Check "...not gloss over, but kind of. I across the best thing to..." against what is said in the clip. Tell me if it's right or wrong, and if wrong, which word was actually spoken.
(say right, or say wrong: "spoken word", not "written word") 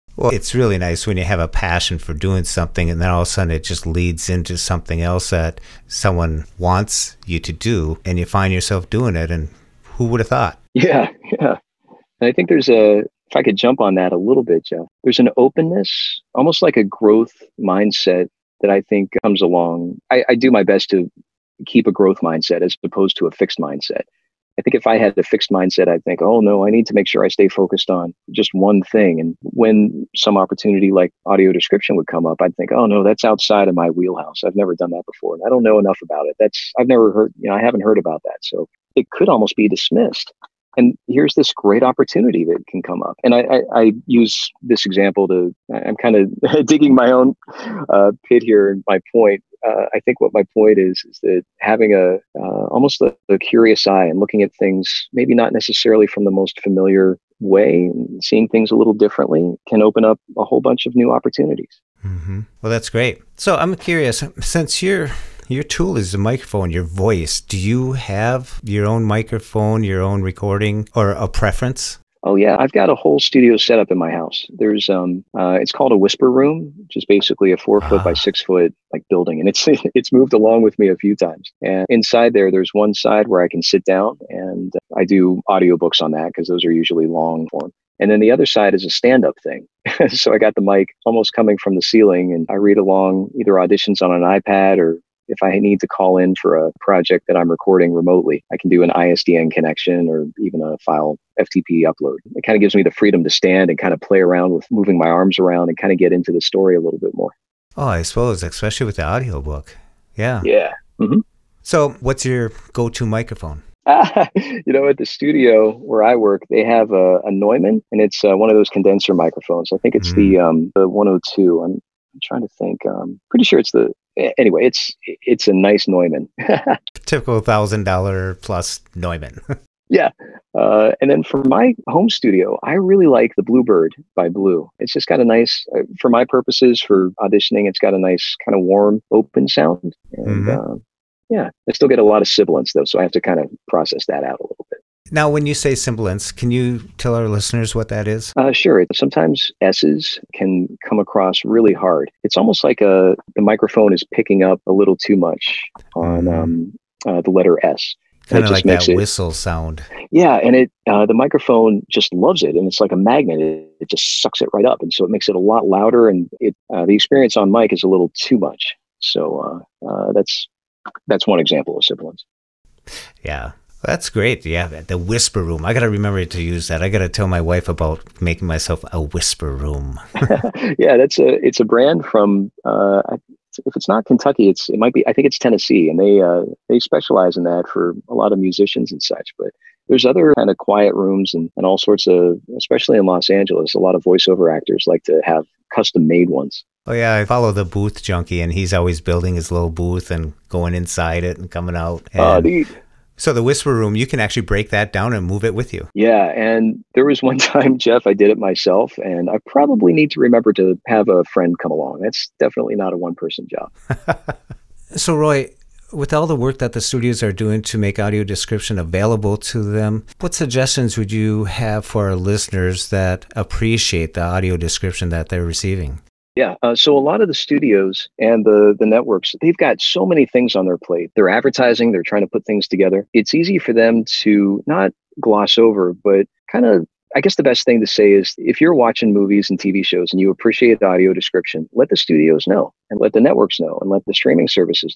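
wrong: "guess", not "across".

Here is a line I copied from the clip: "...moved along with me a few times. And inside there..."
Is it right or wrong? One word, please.
right.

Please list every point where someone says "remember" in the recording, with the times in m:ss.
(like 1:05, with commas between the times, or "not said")
2:55, 3:30.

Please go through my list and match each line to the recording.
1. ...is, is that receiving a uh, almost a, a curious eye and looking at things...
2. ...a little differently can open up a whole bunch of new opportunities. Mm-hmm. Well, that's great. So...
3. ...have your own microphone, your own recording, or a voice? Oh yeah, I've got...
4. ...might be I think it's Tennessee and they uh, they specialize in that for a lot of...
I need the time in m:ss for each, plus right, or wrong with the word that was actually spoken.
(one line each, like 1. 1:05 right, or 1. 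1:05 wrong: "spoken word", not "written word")
1. 0:50 wrong: "having", not "receiving"
2. 0:58 right
3. 1:07 wrong: "preference", not "voice"
4. 3:04 right.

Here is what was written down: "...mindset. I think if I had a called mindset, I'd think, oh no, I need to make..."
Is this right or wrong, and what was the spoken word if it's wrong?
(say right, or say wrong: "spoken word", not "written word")
wrong: "fixed", not "called".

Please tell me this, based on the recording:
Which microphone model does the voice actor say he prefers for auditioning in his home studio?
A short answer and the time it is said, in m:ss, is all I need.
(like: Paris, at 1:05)
Bluebird, at 2:13.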